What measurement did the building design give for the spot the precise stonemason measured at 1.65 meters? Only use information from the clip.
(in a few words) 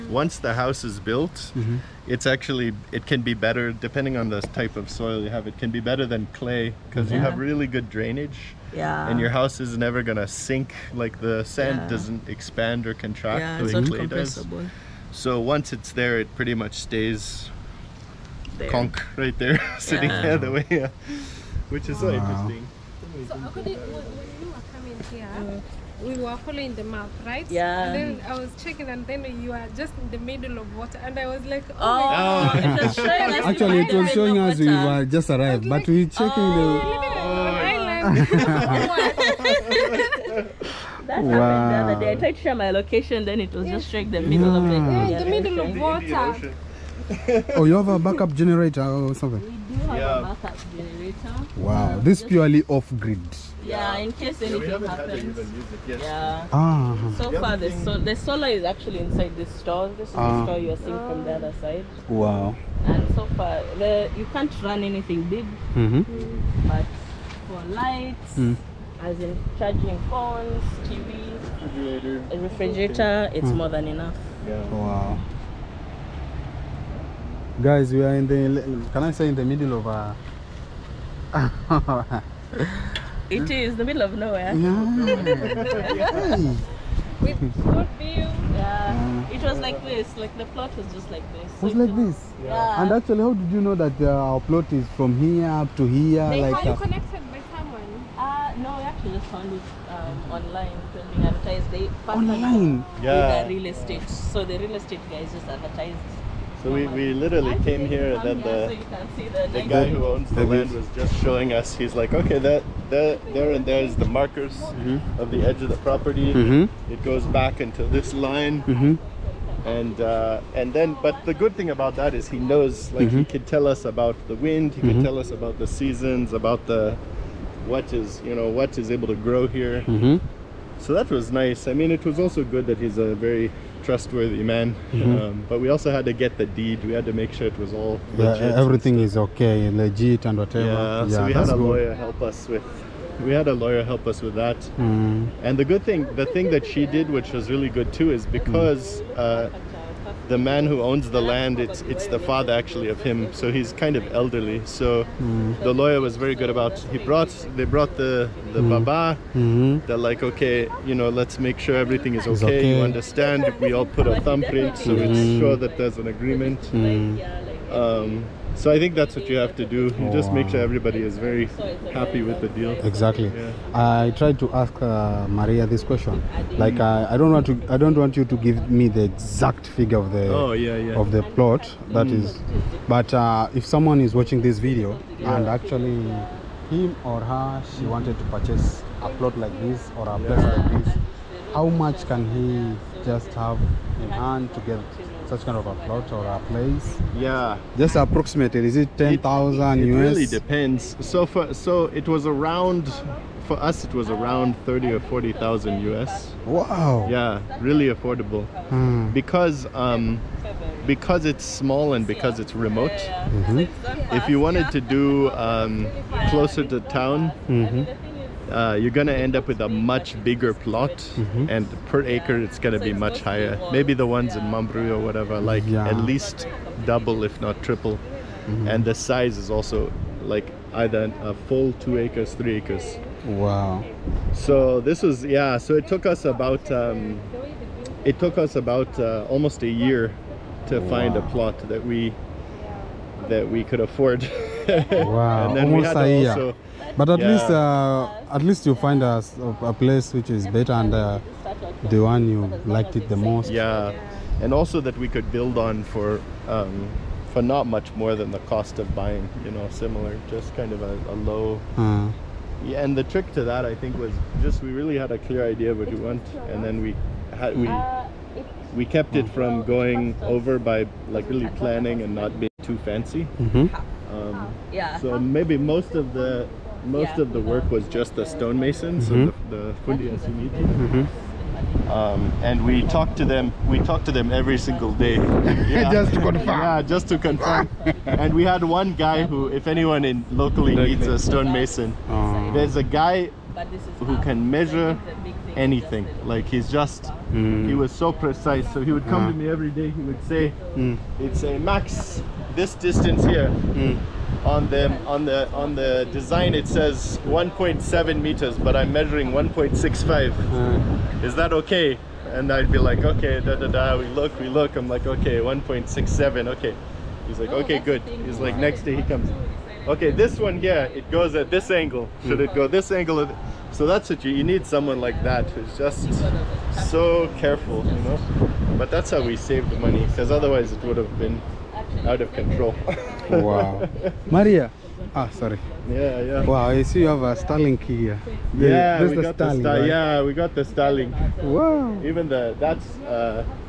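1.7 meters.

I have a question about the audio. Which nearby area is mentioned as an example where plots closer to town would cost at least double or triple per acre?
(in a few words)
Mambrui.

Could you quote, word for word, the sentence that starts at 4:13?
Yeah, and also that we could build on for um, for not much more than the cost of buying.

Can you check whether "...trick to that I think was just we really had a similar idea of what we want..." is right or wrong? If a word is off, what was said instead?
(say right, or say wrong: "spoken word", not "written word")
wrong: "clear", not "similar".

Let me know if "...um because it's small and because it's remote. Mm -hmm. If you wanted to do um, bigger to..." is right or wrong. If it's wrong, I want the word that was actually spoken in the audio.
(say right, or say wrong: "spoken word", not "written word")
wrong: "closer", not "bigger".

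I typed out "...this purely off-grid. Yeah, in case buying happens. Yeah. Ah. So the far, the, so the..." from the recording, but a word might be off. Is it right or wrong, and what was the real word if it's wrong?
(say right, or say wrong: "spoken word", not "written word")
wrong: "anything", not "buying".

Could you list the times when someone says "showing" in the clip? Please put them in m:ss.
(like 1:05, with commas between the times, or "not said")
0:34, 1:51.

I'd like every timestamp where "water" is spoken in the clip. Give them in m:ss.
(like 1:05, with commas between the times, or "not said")
0:30, 0:47.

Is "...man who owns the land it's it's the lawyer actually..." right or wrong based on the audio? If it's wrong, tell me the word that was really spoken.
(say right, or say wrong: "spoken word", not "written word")
wrong: "father", not "lawyer".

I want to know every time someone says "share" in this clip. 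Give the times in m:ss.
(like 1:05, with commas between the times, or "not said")
0:42.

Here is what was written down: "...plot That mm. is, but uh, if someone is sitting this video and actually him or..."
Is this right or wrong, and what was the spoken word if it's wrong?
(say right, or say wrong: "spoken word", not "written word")
wrong: "watching", not "sitting".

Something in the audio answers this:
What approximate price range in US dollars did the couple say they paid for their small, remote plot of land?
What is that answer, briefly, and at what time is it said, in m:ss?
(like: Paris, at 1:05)
30 or 40,000 US, at 3:24.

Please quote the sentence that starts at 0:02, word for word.
it's actually, it can be better, depending on the type of soil you have, it can be better than clay because yeah.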